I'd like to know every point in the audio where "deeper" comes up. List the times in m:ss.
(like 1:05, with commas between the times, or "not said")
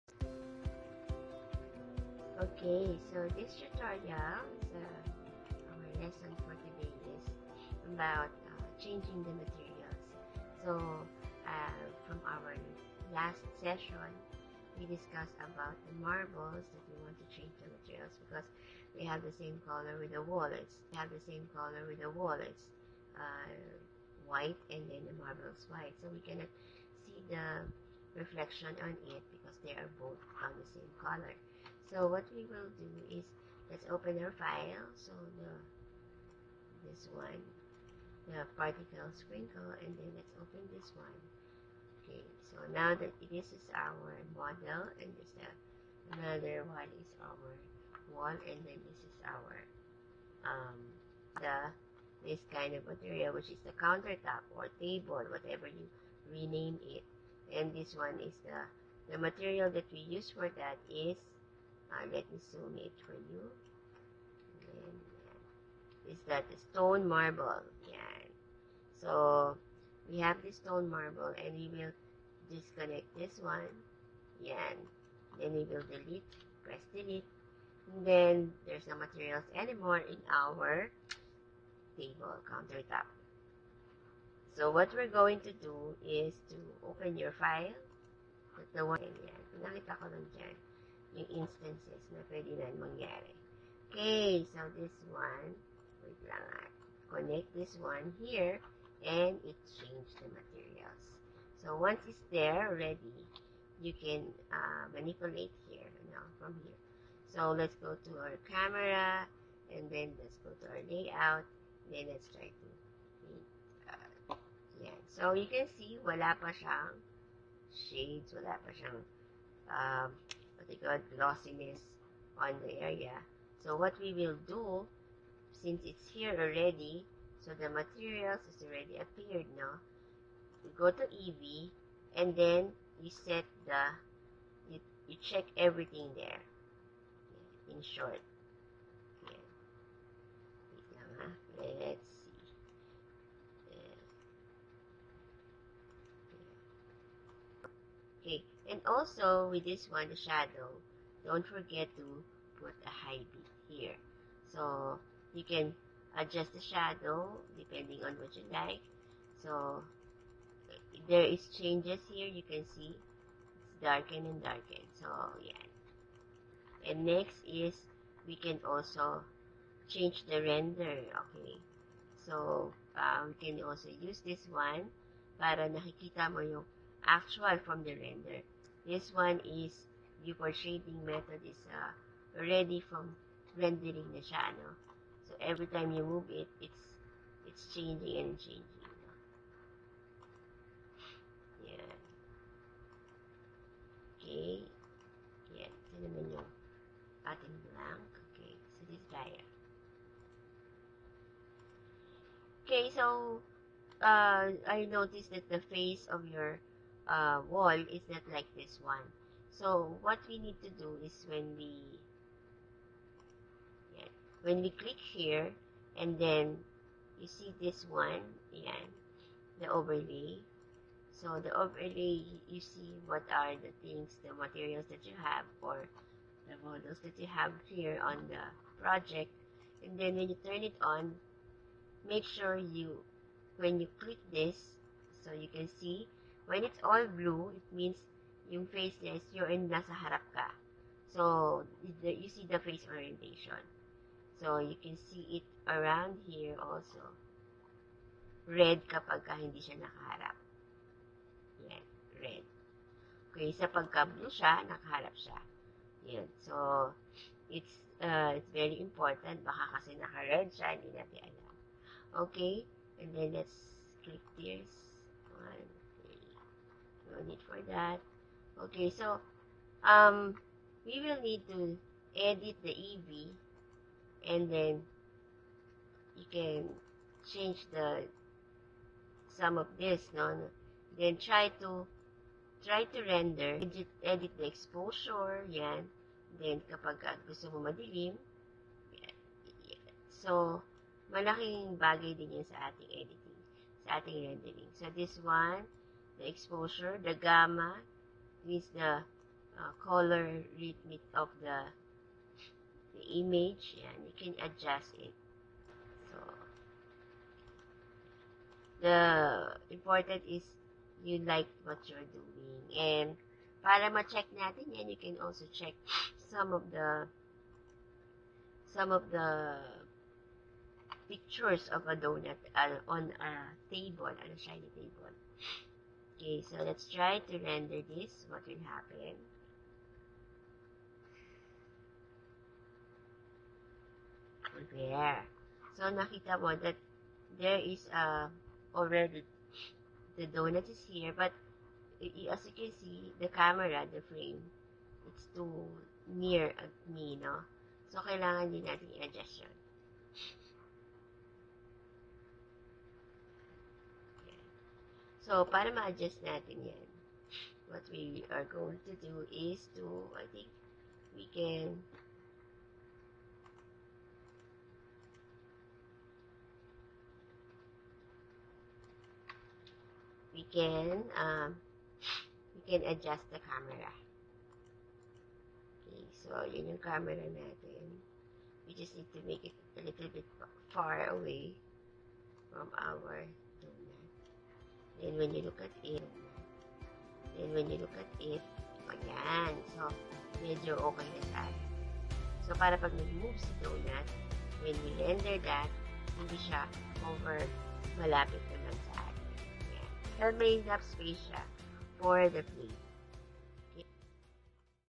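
not said.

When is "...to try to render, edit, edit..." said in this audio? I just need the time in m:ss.
4:41.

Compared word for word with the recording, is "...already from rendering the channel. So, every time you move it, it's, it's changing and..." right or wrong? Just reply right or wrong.
right.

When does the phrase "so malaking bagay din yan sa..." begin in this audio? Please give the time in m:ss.
4:50.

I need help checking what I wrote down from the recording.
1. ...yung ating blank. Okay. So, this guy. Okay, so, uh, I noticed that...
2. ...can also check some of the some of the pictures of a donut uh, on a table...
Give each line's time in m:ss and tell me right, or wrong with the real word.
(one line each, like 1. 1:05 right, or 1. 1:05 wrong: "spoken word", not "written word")
1. 3:16 right
2. 5:14 right.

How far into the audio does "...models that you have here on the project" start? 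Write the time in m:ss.
3:46.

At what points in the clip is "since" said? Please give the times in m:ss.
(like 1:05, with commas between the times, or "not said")
2:05.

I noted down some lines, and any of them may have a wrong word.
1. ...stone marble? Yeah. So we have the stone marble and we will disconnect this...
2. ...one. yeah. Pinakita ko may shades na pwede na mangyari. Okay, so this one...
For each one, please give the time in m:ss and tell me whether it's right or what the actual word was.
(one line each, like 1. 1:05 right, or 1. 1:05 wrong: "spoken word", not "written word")
1. 1:06 right
2. 1:28 wrong: "instances", not "shades".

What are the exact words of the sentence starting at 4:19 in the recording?
Baka kasi naka-red siya, hindi natin alam.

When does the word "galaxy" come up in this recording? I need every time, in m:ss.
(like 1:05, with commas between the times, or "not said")
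not said.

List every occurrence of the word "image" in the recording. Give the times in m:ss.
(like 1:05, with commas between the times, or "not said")
5:03.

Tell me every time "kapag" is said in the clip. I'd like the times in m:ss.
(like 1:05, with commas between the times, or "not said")
4:08, 4:46.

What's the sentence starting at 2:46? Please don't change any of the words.
And next is we can also change the render.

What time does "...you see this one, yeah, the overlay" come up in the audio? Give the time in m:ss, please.
3:37.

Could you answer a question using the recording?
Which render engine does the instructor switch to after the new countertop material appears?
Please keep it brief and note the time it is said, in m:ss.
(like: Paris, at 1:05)
Eevee, at 2:11.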